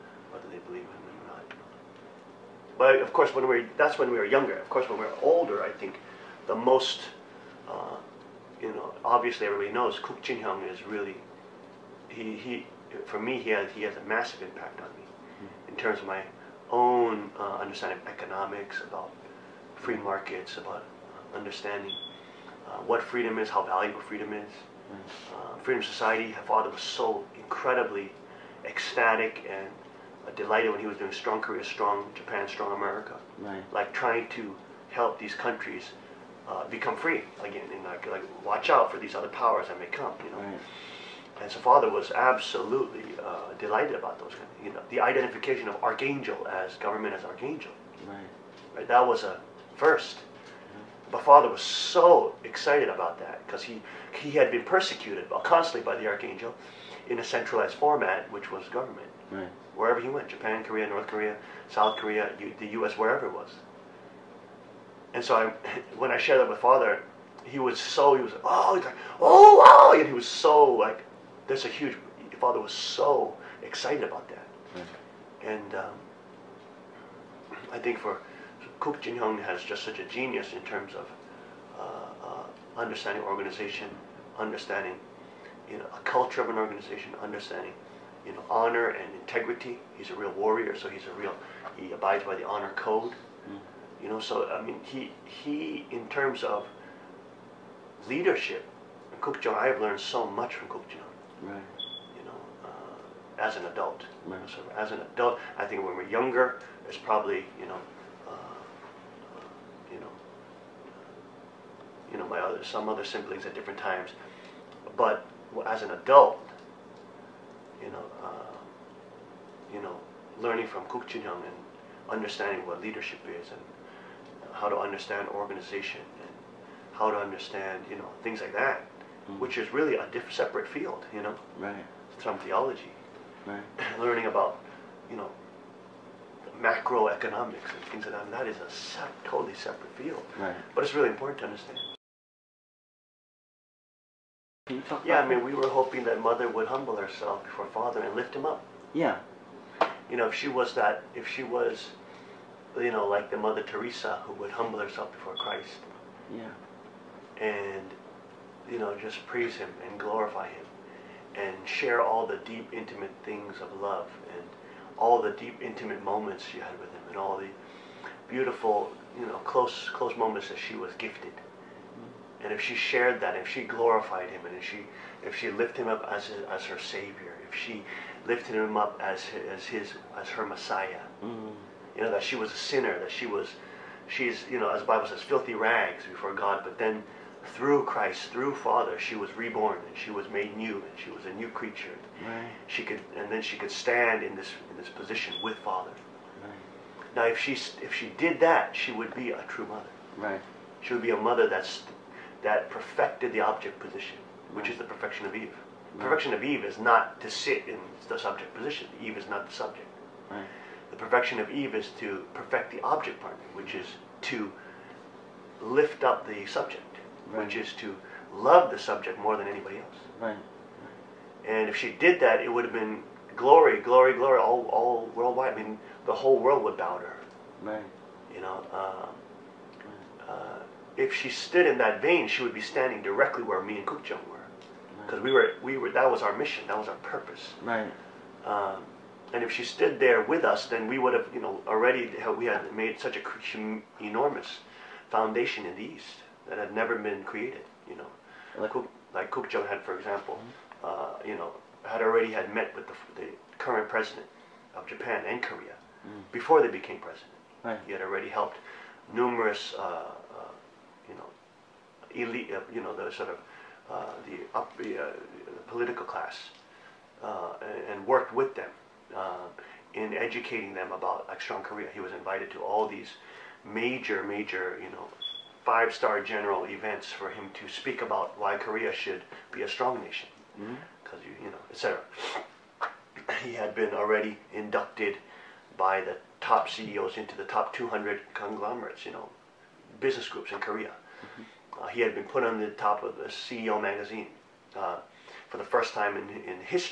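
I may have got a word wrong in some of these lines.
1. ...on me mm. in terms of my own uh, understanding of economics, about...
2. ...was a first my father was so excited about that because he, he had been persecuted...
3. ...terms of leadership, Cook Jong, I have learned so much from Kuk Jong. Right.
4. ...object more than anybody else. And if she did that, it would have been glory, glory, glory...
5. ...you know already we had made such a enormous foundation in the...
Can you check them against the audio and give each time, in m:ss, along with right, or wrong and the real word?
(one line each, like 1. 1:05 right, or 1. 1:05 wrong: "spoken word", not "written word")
1. 0:14 right
2. 0:49 right
3. 1:36 right
4. 3:38 wrong: "subject", not "object"
5. 4:01 right.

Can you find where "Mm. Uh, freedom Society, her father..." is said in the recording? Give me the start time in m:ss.
0:24.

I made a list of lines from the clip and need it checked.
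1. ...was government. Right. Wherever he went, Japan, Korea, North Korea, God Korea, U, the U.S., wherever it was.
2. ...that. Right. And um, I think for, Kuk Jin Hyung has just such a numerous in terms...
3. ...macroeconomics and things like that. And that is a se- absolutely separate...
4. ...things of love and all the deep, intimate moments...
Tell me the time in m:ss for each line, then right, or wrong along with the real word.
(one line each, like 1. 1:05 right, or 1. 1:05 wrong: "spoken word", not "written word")
1. 0:58 wrong: "South", not "God"
2. 1:14 wrong: "genius", not "numerous"
3. 2:16 wrong: "totally", not "absolutely"
4. 2:43 right.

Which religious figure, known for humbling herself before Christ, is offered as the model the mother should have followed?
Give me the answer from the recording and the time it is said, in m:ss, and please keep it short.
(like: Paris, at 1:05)
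Mother Teresa, at 2:33.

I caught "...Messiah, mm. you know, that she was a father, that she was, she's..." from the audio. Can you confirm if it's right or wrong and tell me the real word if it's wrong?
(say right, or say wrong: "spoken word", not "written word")
wrong: "sinner", not "father".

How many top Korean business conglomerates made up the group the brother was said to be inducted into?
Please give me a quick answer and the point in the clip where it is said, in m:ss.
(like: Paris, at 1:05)
200, at 4:47.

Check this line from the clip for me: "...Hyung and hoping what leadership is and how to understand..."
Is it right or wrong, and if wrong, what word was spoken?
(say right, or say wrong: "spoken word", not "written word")
wrong: "understanding", not "hoping".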